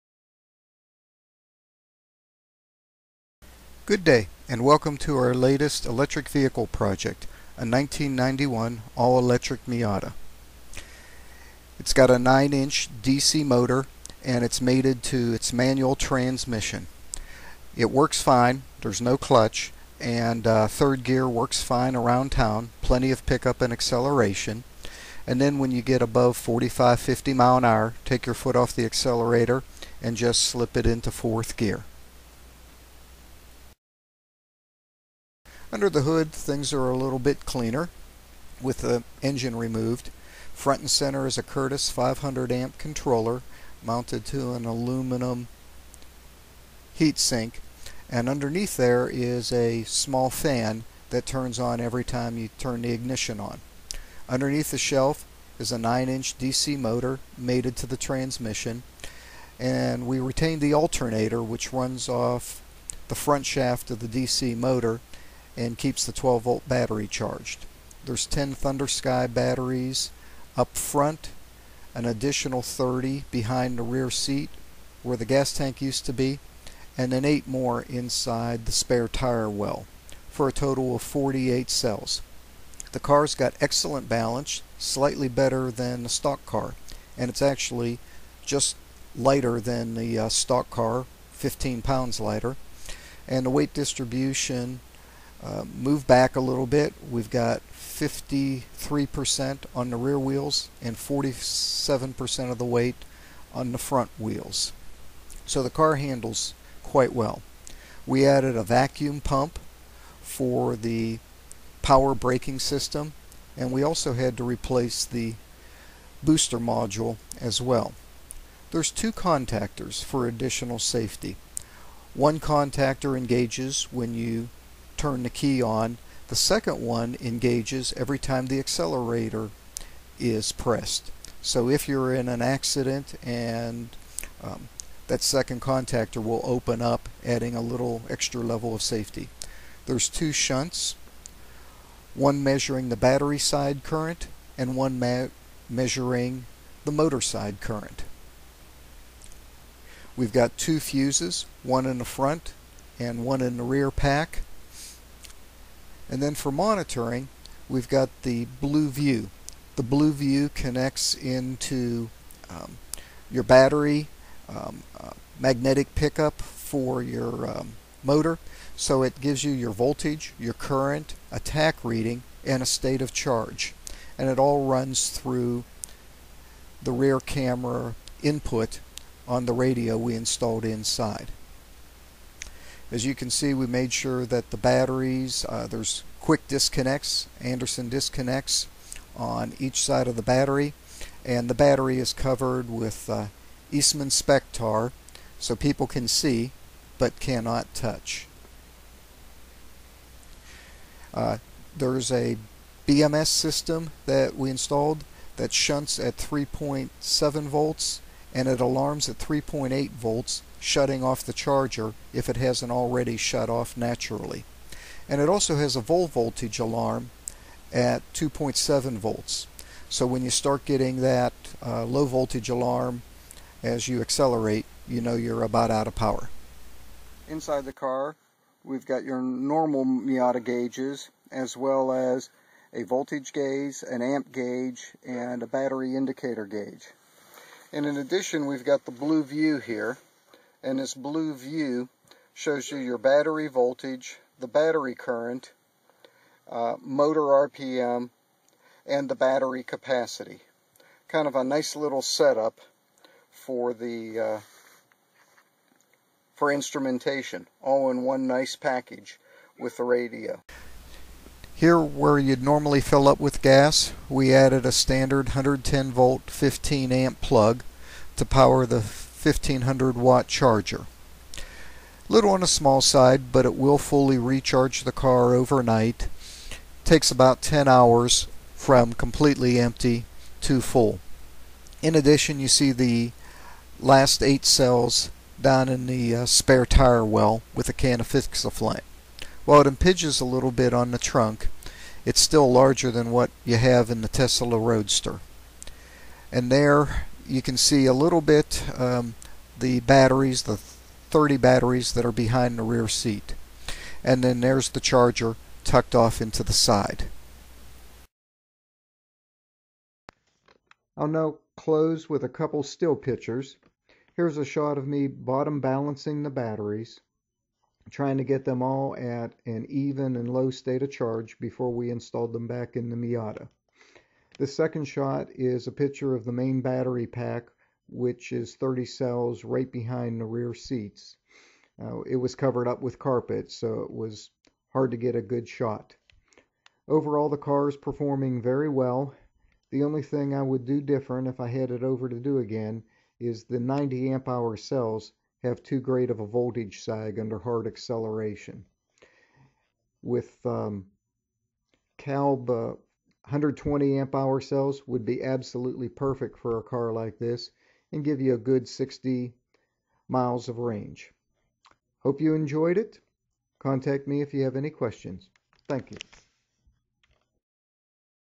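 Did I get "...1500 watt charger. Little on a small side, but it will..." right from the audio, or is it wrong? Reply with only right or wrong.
right.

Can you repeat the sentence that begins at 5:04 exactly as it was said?
And then there's the charger tucked off into the side.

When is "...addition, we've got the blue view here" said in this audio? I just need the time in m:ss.
3:57.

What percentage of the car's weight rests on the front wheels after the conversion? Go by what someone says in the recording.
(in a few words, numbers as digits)
47%.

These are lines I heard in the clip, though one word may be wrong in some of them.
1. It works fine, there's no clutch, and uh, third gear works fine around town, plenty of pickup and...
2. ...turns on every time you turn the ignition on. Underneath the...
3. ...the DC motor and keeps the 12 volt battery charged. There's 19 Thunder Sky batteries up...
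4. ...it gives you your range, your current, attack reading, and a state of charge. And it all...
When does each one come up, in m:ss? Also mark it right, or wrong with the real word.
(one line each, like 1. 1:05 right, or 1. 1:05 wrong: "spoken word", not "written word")
1. 0:17 right
2. 0:51 right
3. 1:03 wrong: "10", not "19"
4. 2:49 wrong: "voltage", not "range".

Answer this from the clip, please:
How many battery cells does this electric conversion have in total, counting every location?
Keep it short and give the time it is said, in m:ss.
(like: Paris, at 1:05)
48, at 1:21.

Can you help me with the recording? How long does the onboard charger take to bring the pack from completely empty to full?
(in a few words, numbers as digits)
10 hours.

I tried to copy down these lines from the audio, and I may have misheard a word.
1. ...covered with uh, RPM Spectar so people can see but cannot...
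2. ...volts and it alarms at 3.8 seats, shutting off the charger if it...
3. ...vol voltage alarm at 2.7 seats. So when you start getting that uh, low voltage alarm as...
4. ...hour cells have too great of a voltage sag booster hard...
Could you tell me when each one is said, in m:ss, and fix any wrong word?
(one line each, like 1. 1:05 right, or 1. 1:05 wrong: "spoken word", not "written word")
1. 3:12 wrong: "Eastman", not "RPM"
2. 3:27 wrong: "volts", not "seats"
3. 3:35 wrong: "volts", not "seats"
4. 5:44 wrong: "under", not "booster".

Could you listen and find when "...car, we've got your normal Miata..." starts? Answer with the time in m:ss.
3:47.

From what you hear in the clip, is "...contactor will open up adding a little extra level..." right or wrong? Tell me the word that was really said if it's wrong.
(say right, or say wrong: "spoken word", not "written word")
right.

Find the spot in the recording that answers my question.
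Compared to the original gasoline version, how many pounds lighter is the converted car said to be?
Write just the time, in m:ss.
1:31.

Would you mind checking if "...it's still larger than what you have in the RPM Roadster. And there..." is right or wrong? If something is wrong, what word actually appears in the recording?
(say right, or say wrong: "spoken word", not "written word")
wrong: "Tesla", not "RPM".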